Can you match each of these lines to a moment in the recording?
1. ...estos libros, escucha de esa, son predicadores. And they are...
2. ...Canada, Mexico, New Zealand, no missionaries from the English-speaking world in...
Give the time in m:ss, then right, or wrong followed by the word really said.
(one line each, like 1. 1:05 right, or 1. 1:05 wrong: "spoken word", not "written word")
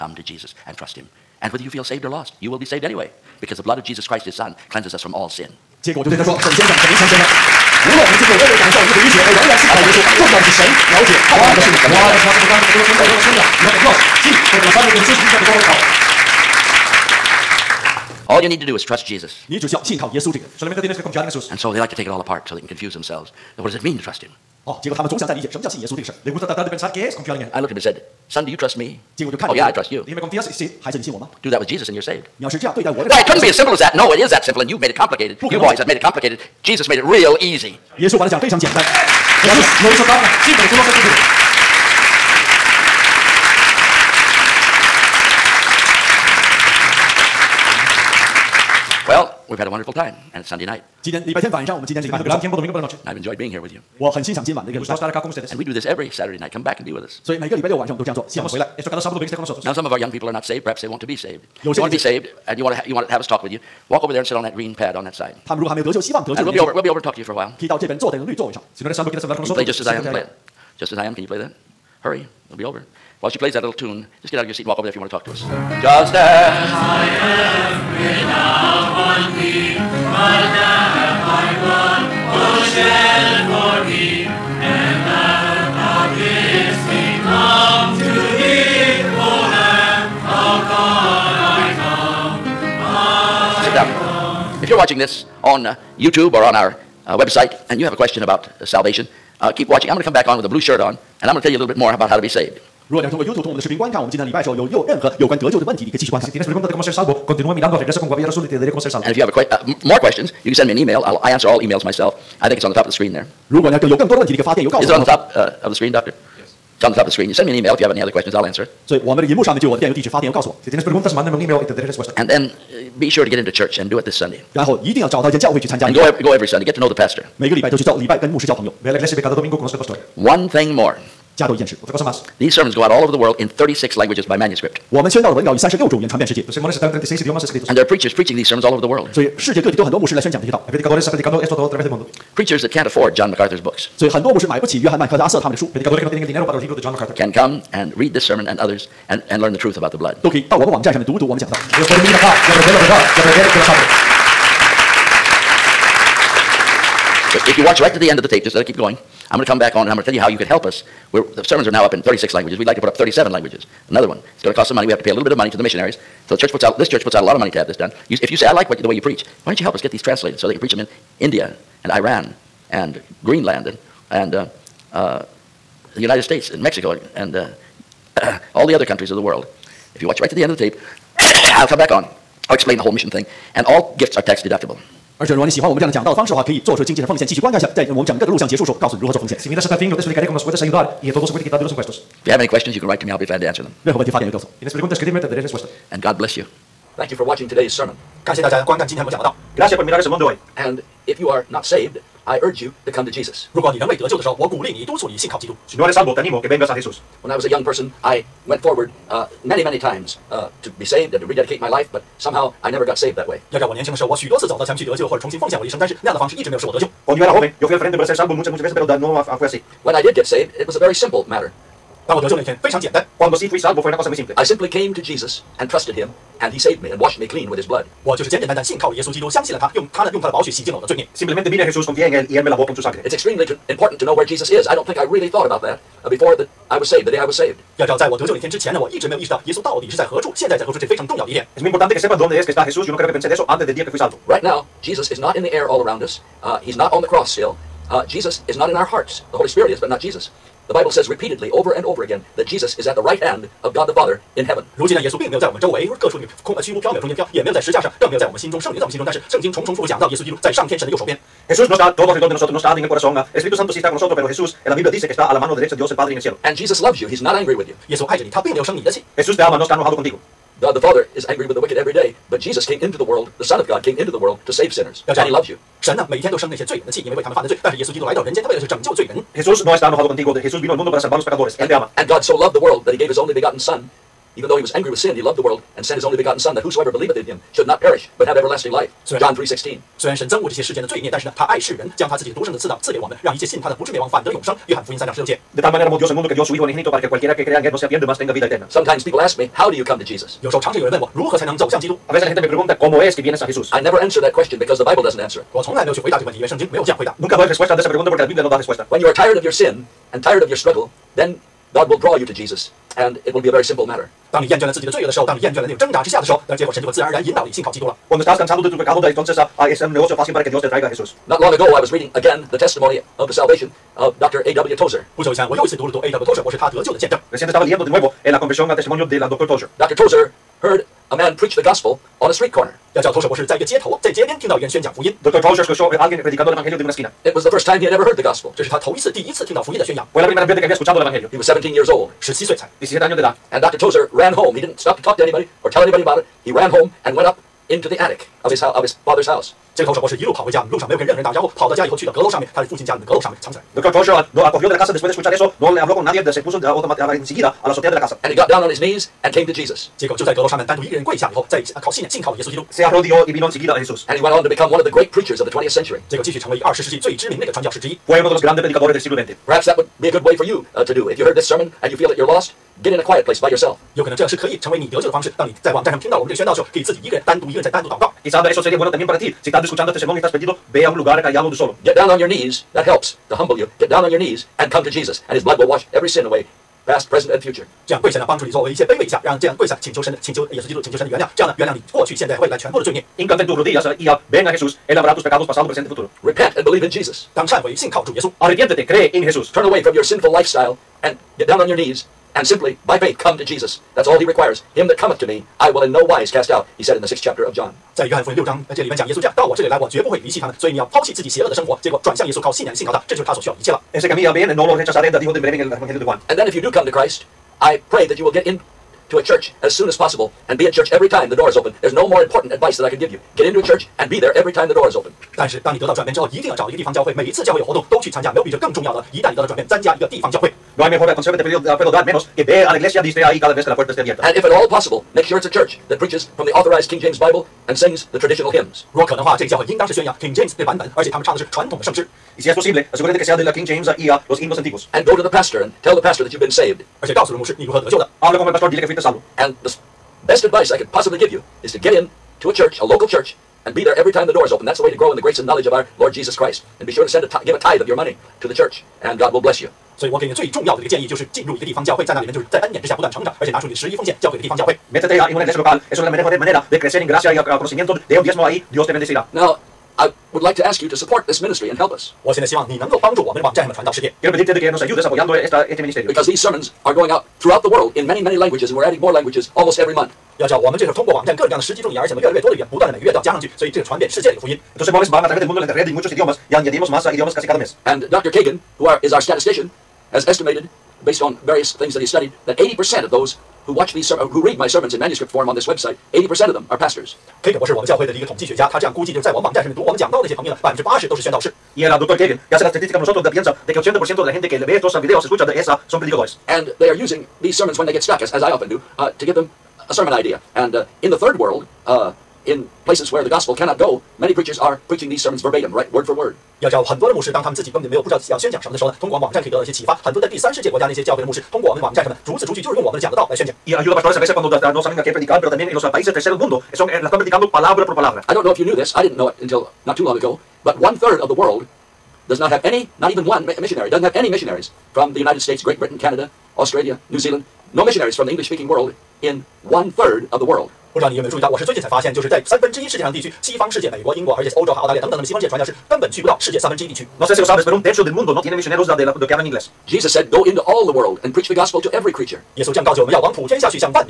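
1. 8:24 wrong: "videos", not "libros"
2. 8:55 wrong: "Australia", not "Mexico".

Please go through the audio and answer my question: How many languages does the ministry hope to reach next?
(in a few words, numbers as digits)
37.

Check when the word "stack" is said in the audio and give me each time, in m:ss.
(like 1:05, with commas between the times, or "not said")
not said.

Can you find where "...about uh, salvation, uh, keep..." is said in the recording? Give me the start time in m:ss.
1:38.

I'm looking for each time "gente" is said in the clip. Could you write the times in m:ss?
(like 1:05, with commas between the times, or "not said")
5:02, 8:24.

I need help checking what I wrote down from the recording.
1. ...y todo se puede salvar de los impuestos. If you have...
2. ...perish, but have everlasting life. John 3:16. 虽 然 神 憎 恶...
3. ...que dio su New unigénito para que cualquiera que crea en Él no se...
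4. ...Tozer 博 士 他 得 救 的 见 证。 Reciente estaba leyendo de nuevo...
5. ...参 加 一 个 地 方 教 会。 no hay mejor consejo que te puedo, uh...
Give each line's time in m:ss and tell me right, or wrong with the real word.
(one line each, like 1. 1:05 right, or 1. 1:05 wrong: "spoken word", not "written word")
1. 3:11 wrong: "quitar", not "salvar"
2. 4:47 right
3. 4:56 wrong: "Hijo", not "New"
4. 5:26 right
5. 7:09 right.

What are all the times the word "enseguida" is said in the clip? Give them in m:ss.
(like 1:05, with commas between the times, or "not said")
5:57, 6:03.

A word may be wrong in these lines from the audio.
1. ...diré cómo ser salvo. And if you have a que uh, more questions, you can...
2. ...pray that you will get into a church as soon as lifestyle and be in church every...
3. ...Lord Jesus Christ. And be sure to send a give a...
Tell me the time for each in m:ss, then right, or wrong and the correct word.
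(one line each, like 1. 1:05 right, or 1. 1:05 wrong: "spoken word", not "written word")
1. 1:48 right
2. 6:57 wrong: "possible", not "lifestyle"
3. 7:35 right.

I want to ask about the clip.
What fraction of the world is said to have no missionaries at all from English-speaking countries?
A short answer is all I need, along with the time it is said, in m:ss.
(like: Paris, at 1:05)
One third, at 8:50.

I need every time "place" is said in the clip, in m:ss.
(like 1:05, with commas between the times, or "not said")
6:13, 8:32.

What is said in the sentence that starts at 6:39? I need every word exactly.
Turn away from your sinful lifestyle and get down on your knees and simply by faith come to Jesus.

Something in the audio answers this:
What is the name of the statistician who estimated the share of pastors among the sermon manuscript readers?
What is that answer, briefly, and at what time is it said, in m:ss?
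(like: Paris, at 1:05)
Dr. Kagan, at 8:08.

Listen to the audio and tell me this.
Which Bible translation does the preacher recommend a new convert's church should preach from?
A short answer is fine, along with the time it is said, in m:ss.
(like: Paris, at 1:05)
King James Bible, at 7:16.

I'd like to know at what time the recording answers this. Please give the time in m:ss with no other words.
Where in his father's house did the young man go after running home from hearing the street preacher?
5:47.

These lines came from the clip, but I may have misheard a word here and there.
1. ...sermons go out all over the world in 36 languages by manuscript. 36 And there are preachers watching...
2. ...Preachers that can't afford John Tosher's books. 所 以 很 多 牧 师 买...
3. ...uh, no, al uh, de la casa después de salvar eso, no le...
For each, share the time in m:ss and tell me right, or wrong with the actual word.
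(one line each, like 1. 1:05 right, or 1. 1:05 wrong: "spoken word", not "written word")
1. 2:12 wrong: "preaching", not "watching"
2. 2:22 wrong: "MacArthur", not "Tosher"
3. 5:54 wrong: "escuchar", not "salvar".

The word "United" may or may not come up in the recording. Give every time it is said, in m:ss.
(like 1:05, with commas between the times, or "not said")
2:55, 8:55.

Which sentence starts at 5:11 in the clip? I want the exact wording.
then God will draw you to Jesus, and it will be a very simple matter.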